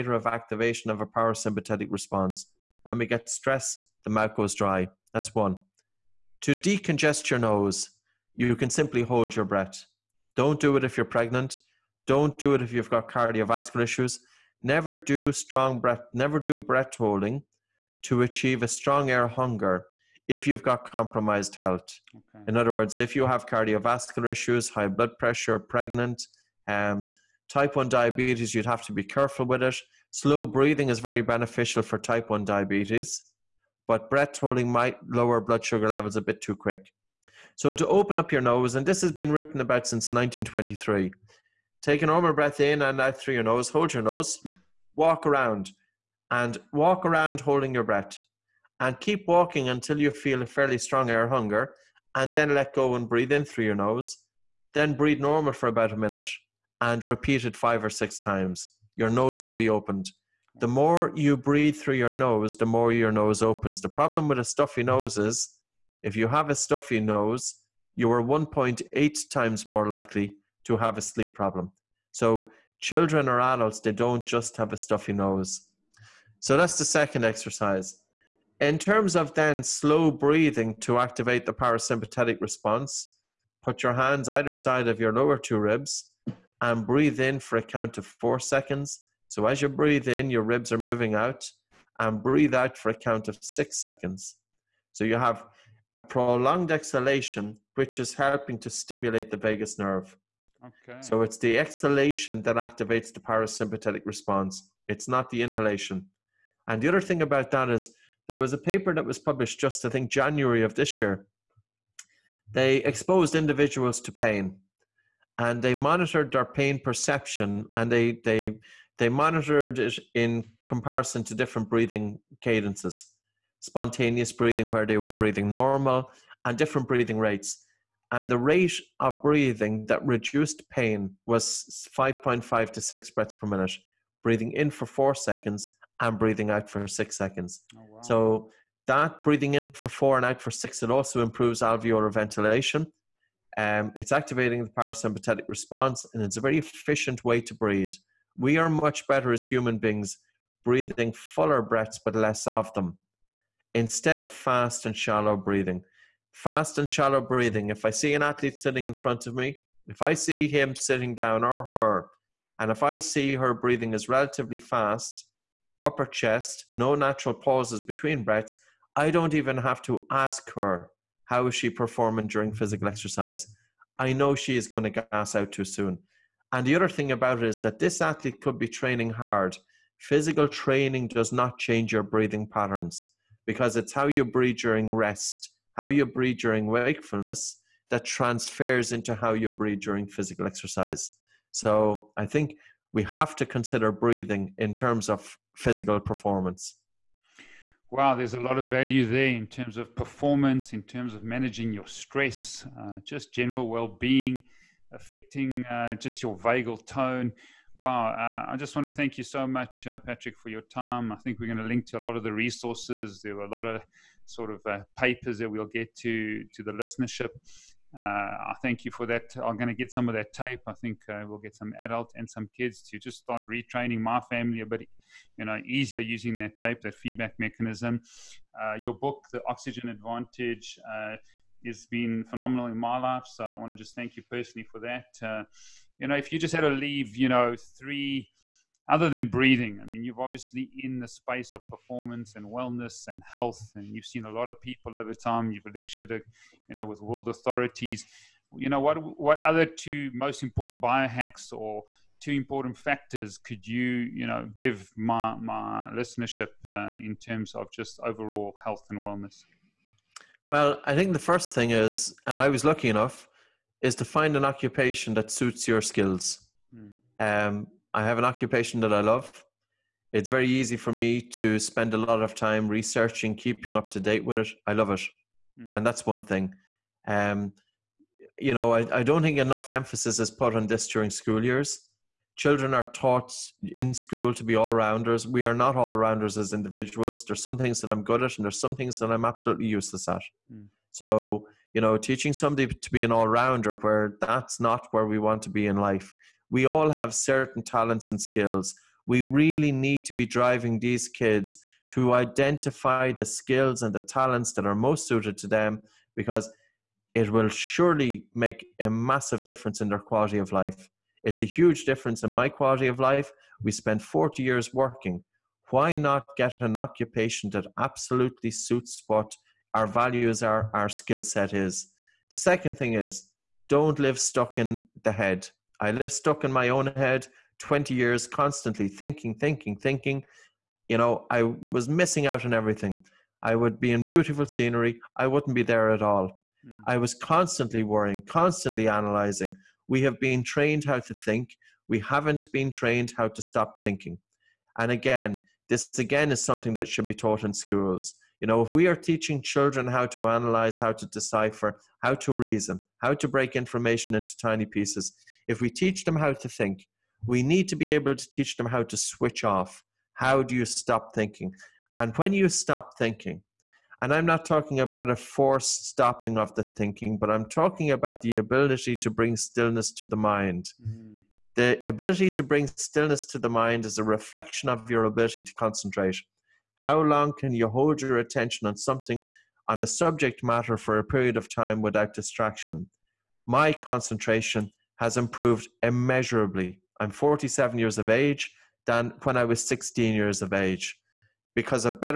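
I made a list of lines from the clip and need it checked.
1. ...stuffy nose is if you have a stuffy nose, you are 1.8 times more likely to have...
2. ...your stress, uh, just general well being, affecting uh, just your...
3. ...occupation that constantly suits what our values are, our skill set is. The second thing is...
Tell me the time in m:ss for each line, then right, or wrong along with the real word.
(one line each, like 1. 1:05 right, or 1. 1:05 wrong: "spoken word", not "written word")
1. 1:04 right
2. 3:21 right
3. 5:16 wrong: "absolutely", not "constantly".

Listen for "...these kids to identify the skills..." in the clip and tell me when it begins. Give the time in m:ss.
5:00.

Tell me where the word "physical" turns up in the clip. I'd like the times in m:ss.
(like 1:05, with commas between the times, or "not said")
2:52, 2:59, 3:10, 3:15.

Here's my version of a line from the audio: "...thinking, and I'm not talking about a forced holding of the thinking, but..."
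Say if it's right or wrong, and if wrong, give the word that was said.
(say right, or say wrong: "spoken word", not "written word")
wrong: "stopping", not "holding".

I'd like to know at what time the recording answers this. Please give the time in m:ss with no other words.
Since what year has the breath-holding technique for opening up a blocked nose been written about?
0:40.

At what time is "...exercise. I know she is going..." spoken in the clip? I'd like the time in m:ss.
2:52.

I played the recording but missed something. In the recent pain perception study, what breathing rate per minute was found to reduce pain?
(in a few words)
5.5 to 6.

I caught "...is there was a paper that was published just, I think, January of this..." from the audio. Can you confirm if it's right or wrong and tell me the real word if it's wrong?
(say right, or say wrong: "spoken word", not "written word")
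right.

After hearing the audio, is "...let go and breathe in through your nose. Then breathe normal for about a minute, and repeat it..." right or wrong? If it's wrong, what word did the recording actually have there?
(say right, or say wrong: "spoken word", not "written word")
right.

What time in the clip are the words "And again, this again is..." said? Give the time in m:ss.
5:44.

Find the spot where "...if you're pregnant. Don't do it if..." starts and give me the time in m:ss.
0:10.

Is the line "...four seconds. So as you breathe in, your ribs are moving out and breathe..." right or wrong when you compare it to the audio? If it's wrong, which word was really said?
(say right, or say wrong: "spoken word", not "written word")
right.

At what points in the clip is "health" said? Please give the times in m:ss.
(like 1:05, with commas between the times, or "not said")
0:21, 4:03, 4:18.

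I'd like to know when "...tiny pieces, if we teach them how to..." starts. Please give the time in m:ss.
5:54.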